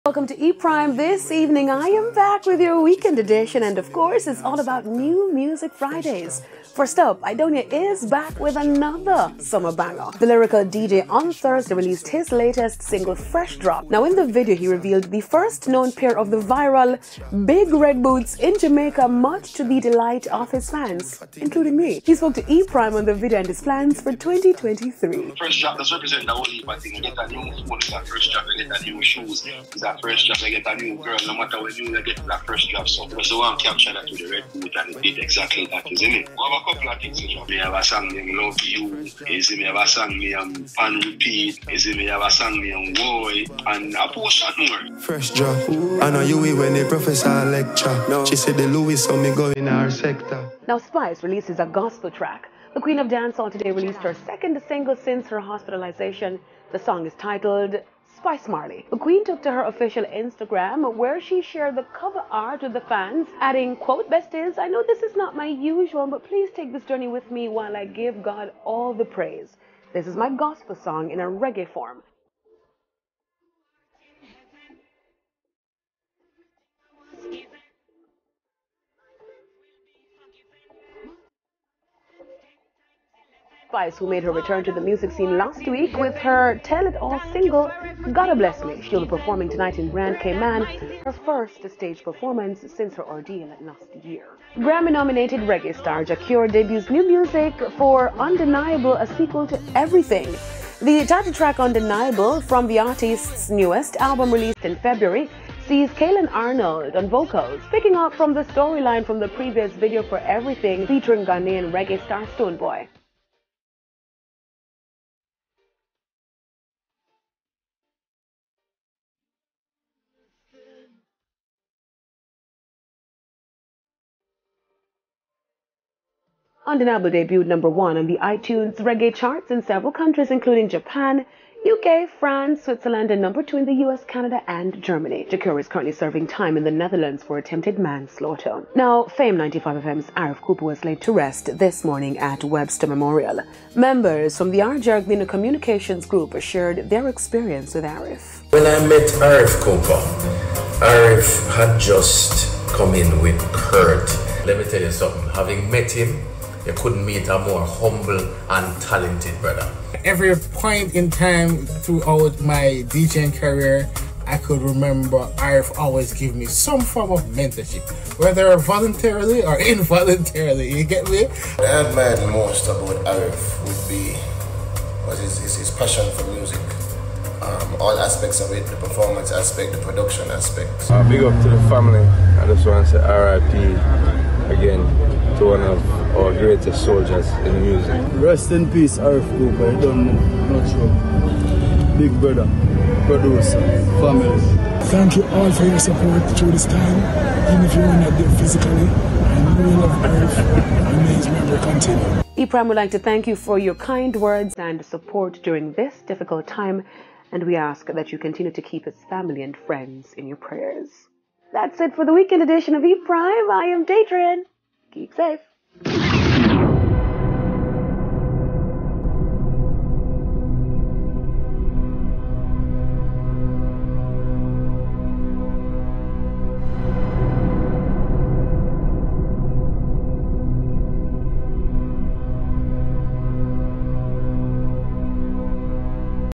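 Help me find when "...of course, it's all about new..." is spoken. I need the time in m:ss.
0:03.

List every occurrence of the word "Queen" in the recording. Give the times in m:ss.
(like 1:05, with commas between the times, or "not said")
0:52, 0:58.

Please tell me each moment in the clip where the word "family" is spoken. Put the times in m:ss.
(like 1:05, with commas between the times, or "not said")
3:01, 3:14, 3:29.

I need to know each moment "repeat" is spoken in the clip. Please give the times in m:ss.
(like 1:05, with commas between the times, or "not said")
0:34, 0:40.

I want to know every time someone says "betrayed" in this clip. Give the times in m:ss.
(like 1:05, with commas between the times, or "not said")
not said.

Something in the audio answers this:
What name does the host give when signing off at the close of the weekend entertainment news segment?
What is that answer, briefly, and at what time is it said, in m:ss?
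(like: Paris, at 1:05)
Daydrin, at 3:33.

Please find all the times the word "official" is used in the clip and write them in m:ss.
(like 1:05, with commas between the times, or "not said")
0:59.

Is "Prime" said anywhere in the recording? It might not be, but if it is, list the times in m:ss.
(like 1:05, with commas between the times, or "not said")
0:00, 0:22, 3:33.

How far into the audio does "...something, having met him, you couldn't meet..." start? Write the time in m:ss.
2:34.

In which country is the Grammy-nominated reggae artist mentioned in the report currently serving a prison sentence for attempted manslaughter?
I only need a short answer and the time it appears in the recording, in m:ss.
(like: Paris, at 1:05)
Netherlands, at 2:16.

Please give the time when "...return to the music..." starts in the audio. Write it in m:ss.
1:24.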